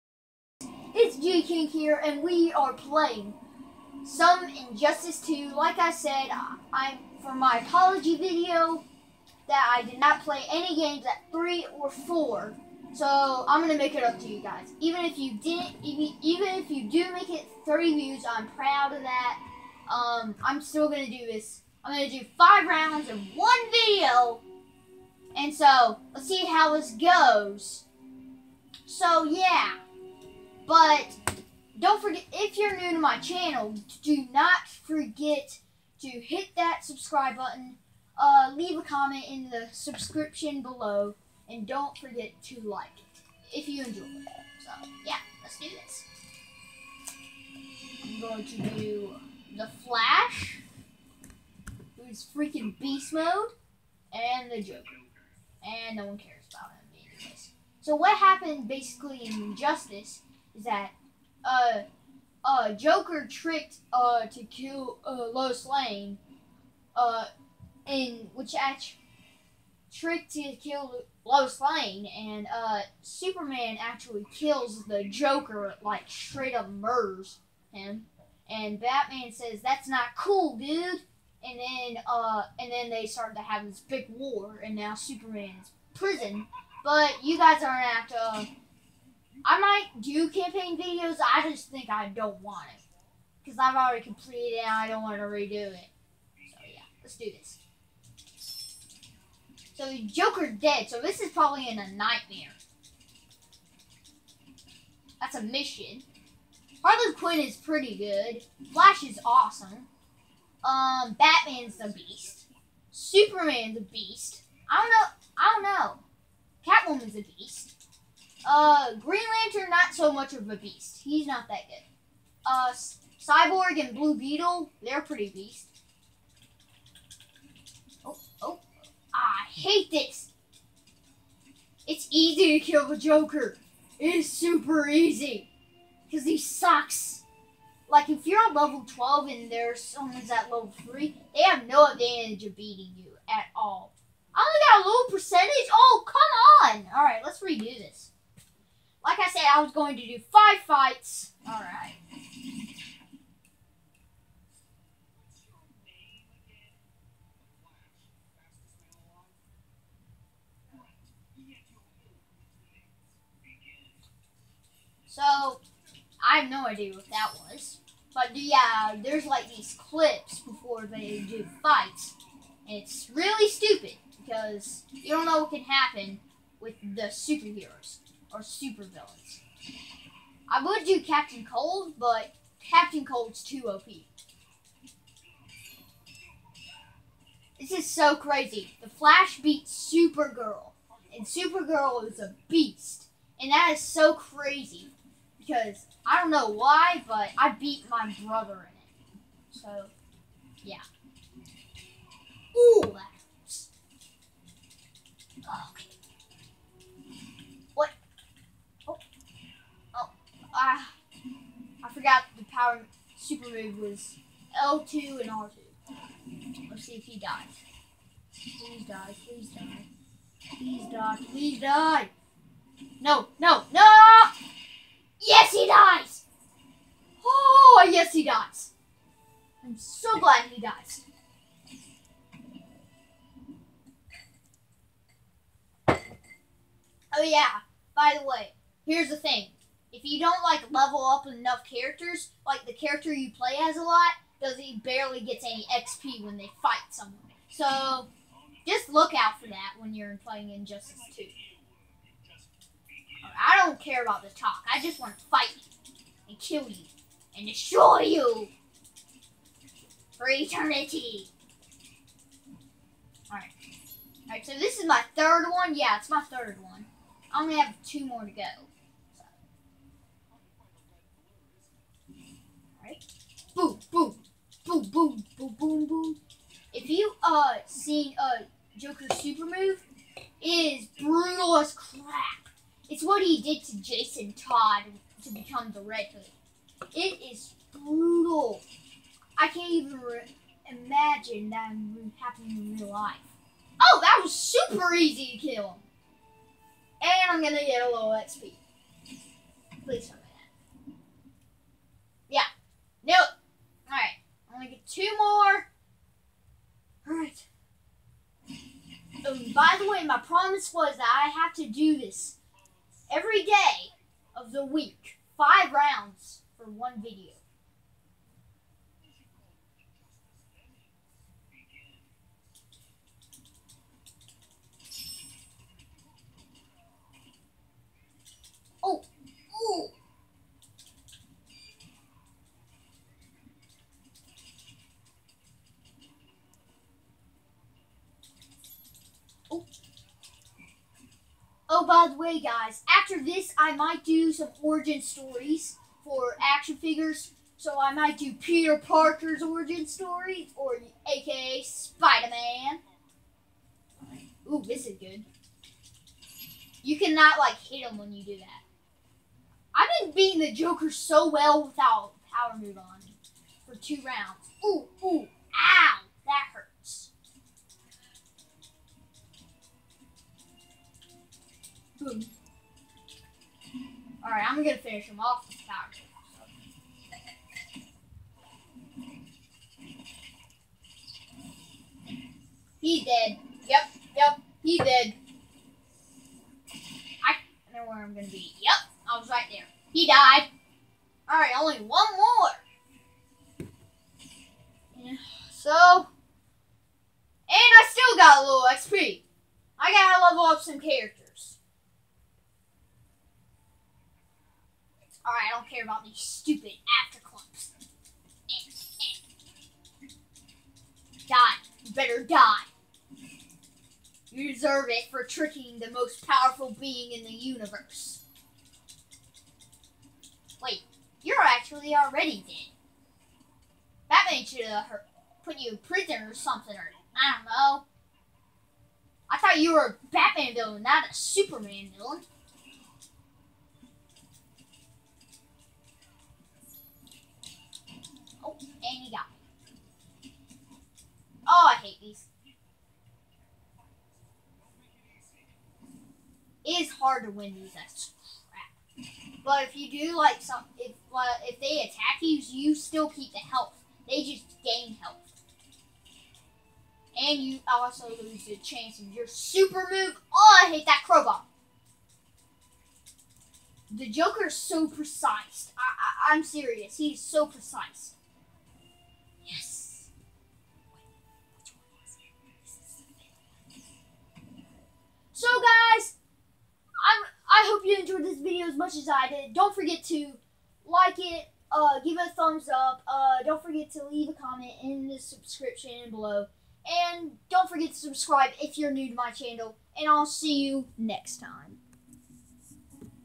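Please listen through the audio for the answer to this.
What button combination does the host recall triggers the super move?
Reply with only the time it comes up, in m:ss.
3:34.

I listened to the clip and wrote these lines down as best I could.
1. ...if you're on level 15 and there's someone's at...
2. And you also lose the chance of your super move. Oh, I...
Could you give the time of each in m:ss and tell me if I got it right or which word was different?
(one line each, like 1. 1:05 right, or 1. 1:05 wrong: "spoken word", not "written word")
1. 2:18 wrong: "12", not "15"
2. 7:37 right.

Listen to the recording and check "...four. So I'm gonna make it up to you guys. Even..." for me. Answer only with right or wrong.
right.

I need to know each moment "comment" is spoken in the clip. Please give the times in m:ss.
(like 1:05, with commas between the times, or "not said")
0:38, 8:04.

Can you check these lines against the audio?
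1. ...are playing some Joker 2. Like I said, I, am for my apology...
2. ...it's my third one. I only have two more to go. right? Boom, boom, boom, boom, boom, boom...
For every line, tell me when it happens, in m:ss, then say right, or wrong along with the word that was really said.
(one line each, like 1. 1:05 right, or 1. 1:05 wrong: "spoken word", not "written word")
1. 0:02 wrong: "Injustice", not "Joker"
2. 4:25 right.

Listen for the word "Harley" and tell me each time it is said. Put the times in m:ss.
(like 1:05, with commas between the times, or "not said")
1:46.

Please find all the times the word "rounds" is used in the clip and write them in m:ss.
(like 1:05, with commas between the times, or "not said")
0:22, 5:15, 6:04.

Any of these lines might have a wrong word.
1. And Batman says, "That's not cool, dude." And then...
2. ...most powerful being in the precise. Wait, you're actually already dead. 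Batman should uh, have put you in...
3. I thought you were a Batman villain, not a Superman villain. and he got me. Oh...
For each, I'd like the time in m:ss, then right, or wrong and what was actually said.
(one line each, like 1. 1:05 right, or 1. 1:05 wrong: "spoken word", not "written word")
1. 1:18 right
2. 6:55 wrong: "universe", not "precise"
3. 7:09 right.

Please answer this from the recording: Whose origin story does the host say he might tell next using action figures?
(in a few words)
Peter Parker.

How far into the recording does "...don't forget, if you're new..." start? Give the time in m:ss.
0:31.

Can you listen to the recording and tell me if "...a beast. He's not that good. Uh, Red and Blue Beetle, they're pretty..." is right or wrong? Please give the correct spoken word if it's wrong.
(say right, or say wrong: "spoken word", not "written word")
wrong: "Cyborg", not "Red".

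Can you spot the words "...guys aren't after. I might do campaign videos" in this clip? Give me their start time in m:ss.
1:27.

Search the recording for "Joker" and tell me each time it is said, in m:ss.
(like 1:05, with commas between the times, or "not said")
0:54, 1:02, 1:15, 1:40, 2:12, 4:38, 6:00, 7:44.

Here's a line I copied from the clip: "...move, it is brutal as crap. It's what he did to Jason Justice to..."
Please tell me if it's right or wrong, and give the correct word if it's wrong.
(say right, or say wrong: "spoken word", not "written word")
wrong: "Todd", not "Justice".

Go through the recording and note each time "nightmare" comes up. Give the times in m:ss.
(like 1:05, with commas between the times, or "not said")
1:41.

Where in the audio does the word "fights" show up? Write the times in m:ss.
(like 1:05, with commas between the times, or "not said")
2:30, 2:51, 4:06, 4:15.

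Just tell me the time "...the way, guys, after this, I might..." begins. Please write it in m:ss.
5:42.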